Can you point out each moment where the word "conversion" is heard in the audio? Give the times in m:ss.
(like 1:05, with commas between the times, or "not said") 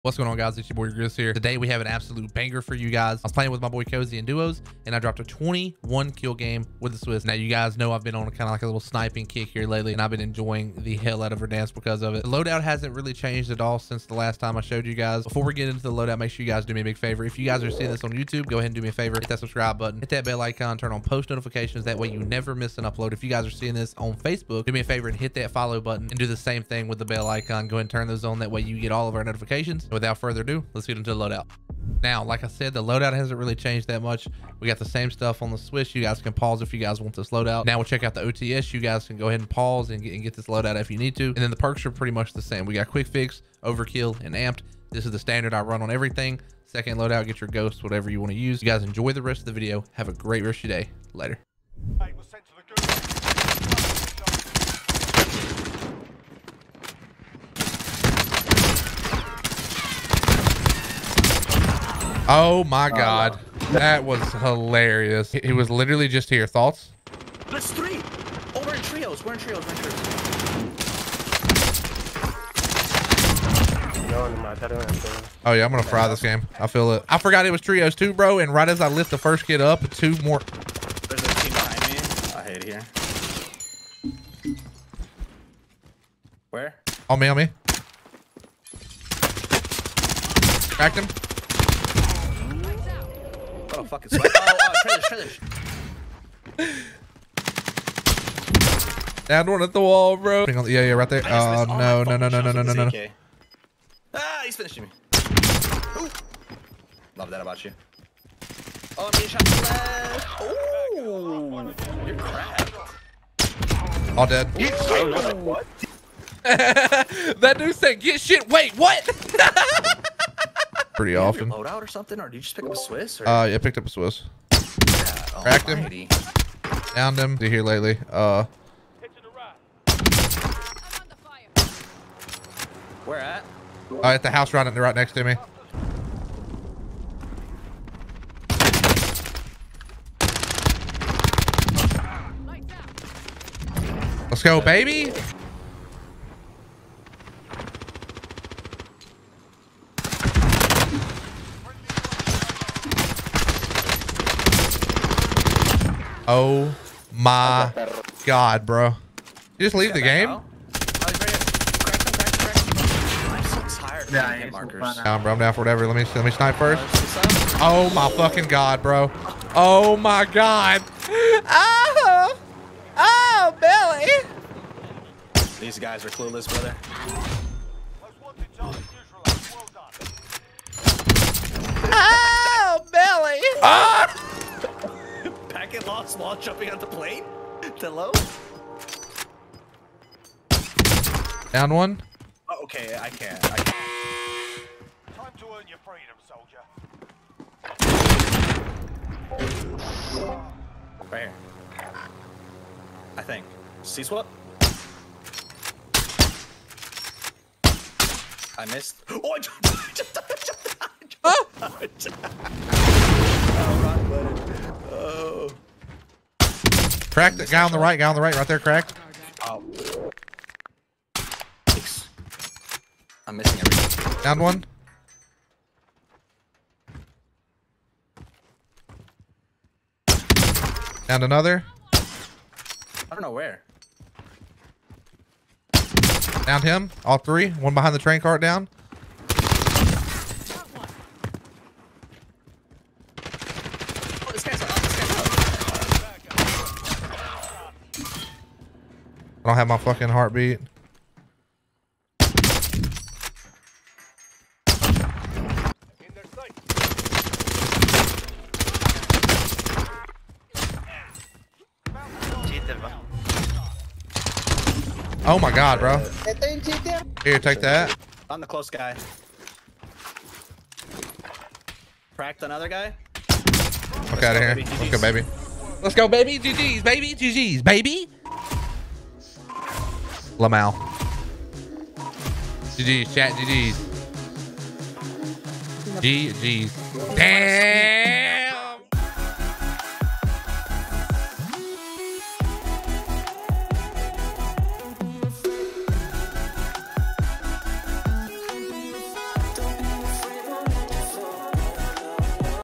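not said.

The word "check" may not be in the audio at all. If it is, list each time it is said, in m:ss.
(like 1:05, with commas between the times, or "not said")
0:37.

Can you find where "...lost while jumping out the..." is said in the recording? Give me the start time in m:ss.
3:05.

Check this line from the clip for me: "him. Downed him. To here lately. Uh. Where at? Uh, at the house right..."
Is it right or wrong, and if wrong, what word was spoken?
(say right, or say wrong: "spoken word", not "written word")
right.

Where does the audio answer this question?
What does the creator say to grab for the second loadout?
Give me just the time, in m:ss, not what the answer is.
0:47.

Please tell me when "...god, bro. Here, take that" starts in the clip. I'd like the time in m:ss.
4:25.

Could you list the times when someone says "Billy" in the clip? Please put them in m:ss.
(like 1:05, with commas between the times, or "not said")
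2:54, 3:02.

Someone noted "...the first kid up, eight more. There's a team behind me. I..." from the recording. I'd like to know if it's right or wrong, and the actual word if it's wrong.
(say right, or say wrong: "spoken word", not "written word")
wrong: "two", not "eight".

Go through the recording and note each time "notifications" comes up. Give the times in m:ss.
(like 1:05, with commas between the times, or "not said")
0:21, 0:29.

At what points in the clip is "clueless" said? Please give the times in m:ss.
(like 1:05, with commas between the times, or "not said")
2:56.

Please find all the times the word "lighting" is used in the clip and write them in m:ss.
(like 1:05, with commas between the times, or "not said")
not said.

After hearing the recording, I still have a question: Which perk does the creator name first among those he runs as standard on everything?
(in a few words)
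Quick Fix.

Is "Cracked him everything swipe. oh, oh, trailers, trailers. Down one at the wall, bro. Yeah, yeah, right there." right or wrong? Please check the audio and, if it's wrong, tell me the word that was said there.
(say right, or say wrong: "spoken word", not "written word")
wrong: "fucking", not "everything".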